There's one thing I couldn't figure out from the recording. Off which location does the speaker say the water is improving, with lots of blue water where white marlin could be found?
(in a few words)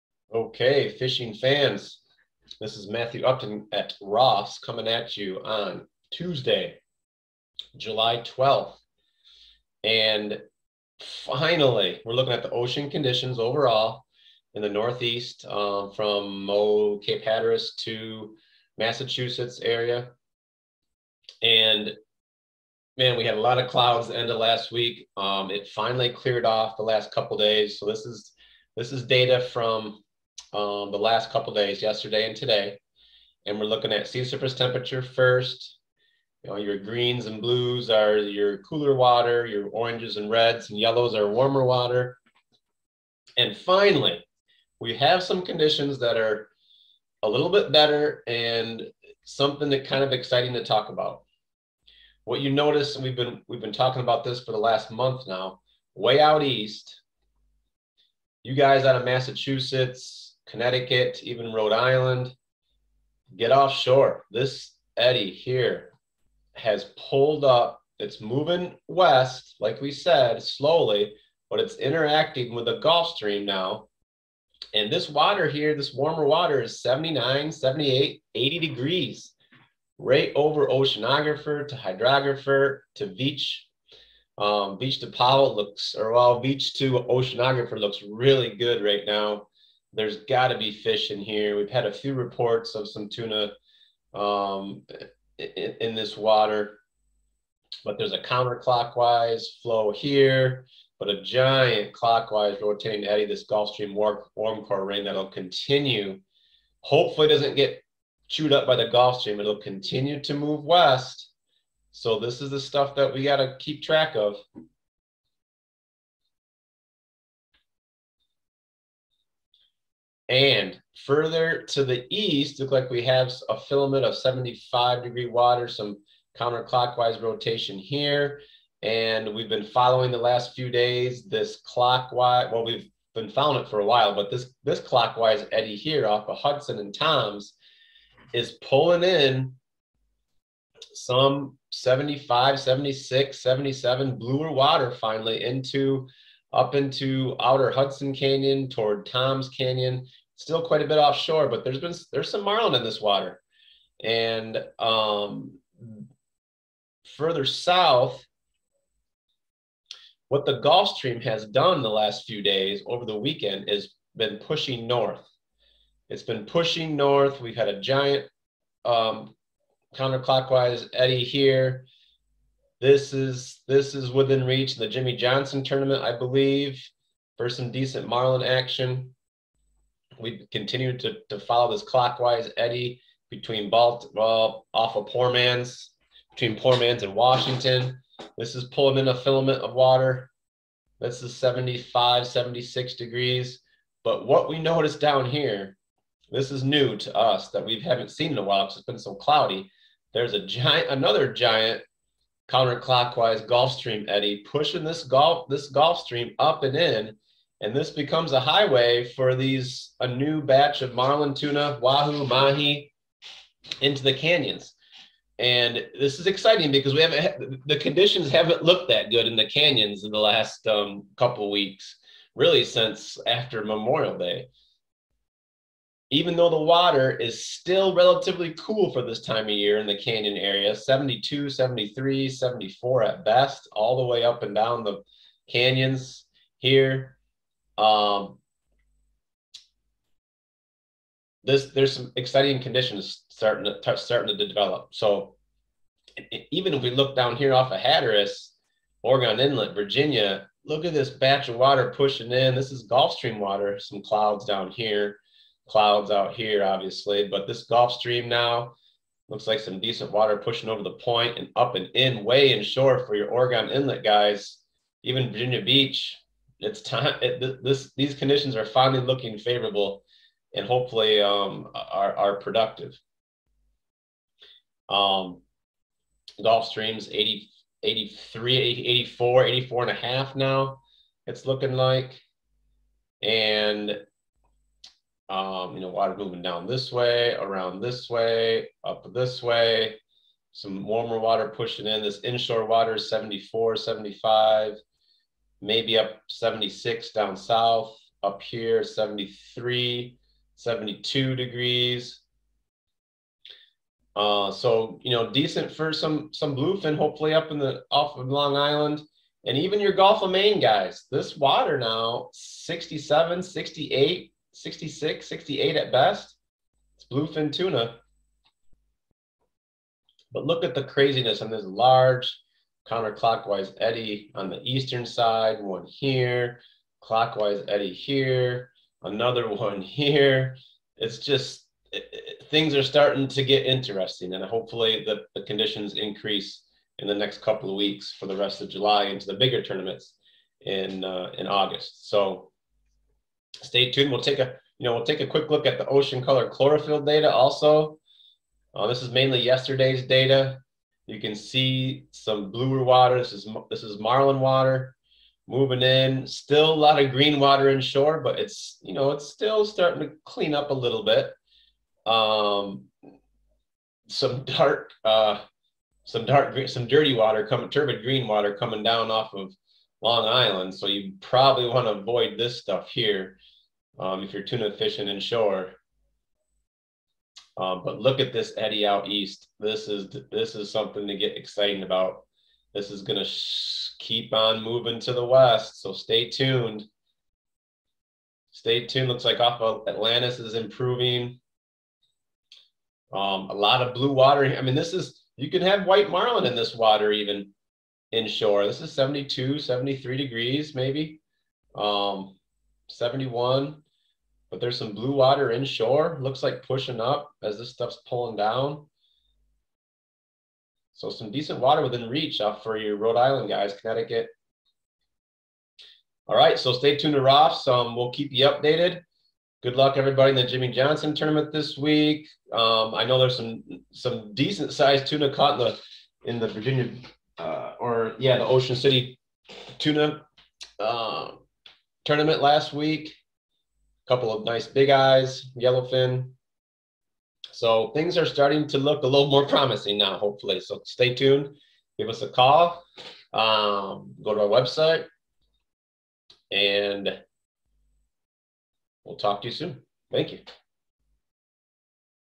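Atlantis.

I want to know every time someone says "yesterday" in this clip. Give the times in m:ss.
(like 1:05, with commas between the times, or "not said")
0:31, 5:49.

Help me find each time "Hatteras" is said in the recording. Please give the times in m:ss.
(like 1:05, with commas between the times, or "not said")
0:17, 4:07.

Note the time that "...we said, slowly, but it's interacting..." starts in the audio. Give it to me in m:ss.
1:09.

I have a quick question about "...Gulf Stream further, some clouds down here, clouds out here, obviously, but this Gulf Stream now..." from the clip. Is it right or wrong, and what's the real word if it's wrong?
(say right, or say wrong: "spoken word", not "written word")
wrong: "water", not "further".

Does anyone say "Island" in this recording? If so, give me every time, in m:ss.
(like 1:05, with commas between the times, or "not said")
1:01, 5:08, 6:10, 6:53.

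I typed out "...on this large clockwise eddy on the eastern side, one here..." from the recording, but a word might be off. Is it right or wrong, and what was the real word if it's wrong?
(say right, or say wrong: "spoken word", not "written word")
wrong: "counterclockwise", not "clockwise".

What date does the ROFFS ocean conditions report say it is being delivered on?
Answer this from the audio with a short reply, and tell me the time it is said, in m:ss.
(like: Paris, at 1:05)
Tuesday, July 12th, at 0:06.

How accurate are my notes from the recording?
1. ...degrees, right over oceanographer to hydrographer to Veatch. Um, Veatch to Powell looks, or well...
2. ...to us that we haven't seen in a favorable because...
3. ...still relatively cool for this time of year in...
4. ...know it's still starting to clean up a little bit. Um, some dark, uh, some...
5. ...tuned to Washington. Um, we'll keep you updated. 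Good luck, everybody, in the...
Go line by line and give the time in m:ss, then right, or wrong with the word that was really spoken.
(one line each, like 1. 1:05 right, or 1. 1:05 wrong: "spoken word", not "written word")
1. 1:18 right
2. 3:16 wrong: "while", not "favorable"
3. 3:47 right
4. 5:58 right
5. 6:56 wrong: "ROFFS", not "Washington".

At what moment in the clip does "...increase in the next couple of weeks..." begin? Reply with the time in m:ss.
5:35.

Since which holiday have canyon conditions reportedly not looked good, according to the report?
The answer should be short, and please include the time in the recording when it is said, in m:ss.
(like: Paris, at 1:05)
Memorial Day, at 3:43.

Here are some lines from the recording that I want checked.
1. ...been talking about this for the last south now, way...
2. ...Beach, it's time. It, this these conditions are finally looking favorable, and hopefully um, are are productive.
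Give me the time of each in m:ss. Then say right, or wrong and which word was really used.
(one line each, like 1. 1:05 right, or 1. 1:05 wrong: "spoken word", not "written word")
1. 0:53 wrong: "month", not "south"
2. 4:25 right.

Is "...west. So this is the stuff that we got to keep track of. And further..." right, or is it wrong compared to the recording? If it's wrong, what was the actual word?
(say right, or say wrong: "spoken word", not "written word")
right.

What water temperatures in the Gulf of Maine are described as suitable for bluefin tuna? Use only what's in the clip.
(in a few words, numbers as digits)
67, 68, 66, 68 degrees.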